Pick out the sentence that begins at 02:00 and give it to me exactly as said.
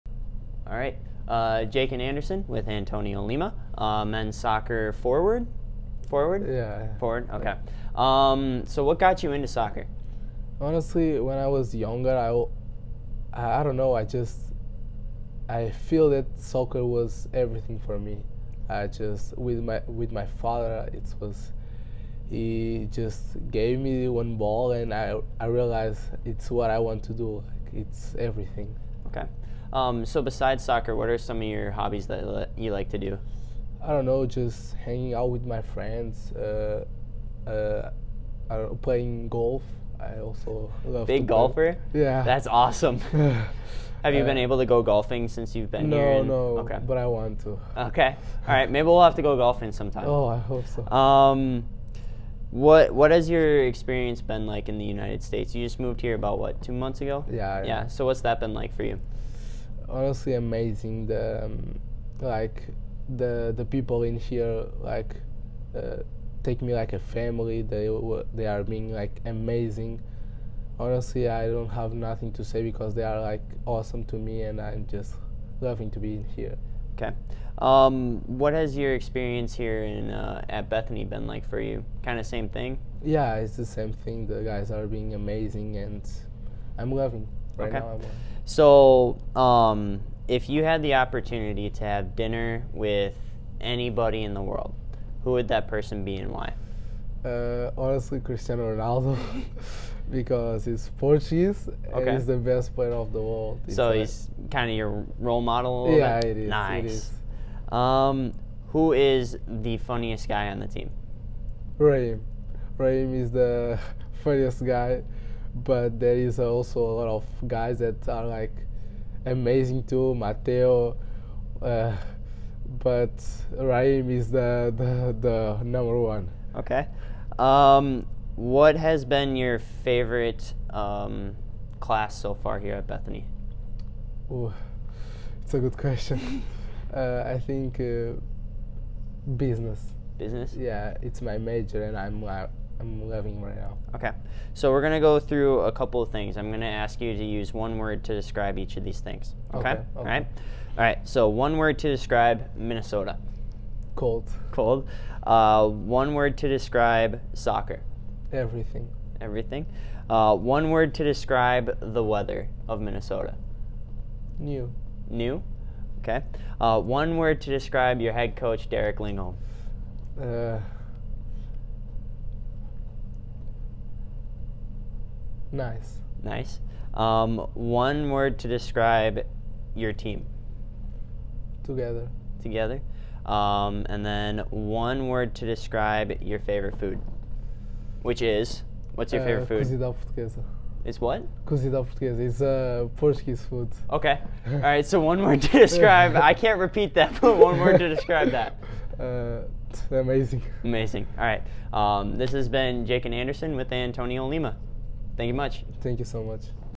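Mateo, uh, but Raheem is the, the, the number one.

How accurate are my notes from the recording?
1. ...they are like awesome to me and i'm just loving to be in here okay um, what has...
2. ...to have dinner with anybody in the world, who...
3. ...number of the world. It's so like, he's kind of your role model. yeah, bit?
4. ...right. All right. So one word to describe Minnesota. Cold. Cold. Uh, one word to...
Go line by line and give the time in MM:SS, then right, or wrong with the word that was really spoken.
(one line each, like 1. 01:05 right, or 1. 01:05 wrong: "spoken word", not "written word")
1. 01:12 right
2. 01:31 right
3. 01:42 wrong: "player", not "number"
4. 02:30 right.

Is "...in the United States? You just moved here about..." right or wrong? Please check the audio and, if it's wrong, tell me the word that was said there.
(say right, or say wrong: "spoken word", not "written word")
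right.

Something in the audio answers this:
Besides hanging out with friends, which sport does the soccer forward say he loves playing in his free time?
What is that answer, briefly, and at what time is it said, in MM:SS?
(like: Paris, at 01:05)
Golf, at 00:38.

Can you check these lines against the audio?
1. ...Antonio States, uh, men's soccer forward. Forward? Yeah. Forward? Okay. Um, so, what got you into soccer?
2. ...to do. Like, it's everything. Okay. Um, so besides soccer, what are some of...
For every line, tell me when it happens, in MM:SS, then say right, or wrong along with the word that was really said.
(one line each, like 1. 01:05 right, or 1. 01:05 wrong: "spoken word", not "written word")
1. 00:02 wrong: "Lima", not "States"
2. 00:27 right.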